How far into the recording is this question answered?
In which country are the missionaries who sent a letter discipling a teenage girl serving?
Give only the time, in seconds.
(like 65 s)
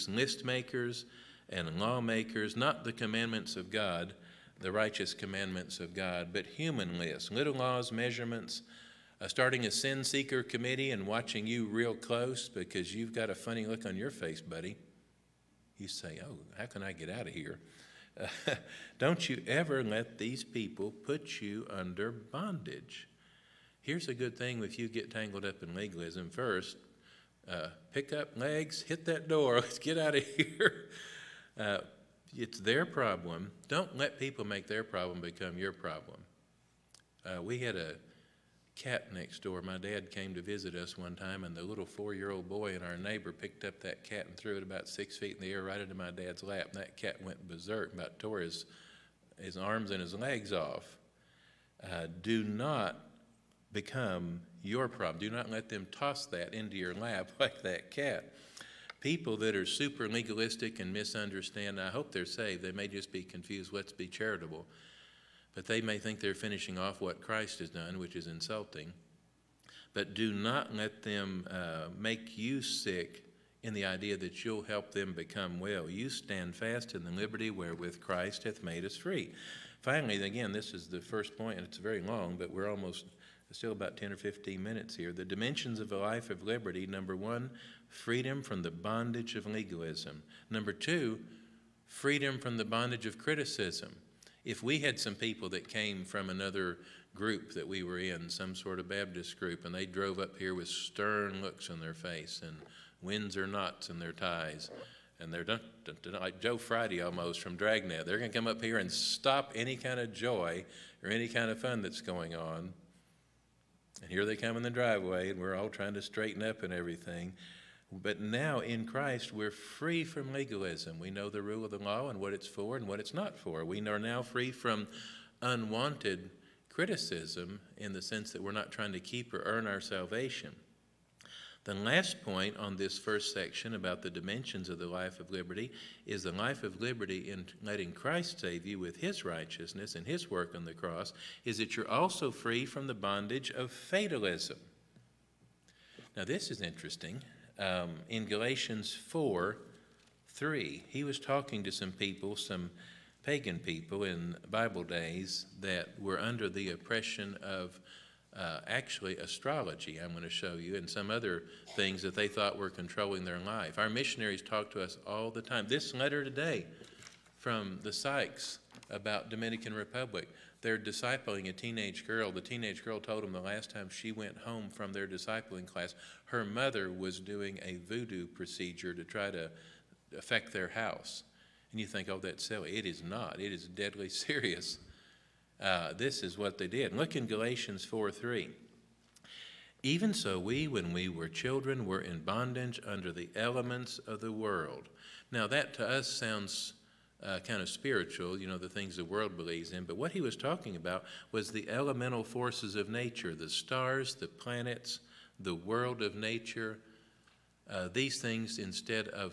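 169 s.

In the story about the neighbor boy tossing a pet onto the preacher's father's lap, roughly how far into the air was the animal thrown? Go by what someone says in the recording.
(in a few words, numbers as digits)
6 feet.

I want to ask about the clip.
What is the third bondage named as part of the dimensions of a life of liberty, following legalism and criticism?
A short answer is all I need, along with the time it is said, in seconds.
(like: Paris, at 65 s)
Fatalism, at 143 s.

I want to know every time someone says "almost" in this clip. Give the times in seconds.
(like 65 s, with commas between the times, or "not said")
82 s, 107 s.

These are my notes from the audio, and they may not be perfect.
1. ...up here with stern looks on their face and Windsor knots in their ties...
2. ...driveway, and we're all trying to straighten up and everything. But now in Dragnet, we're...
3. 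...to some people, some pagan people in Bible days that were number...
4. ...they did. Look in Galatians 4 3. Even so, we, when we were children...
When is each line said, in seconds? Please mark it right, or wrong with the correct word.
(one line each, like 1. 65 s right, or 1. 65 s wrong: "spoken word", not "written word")
1. 100 s right
2. 114 s wrong: "Christ", not "Dragnet"
3. 151 s wrong: "under", not "number"
4. 186 s right.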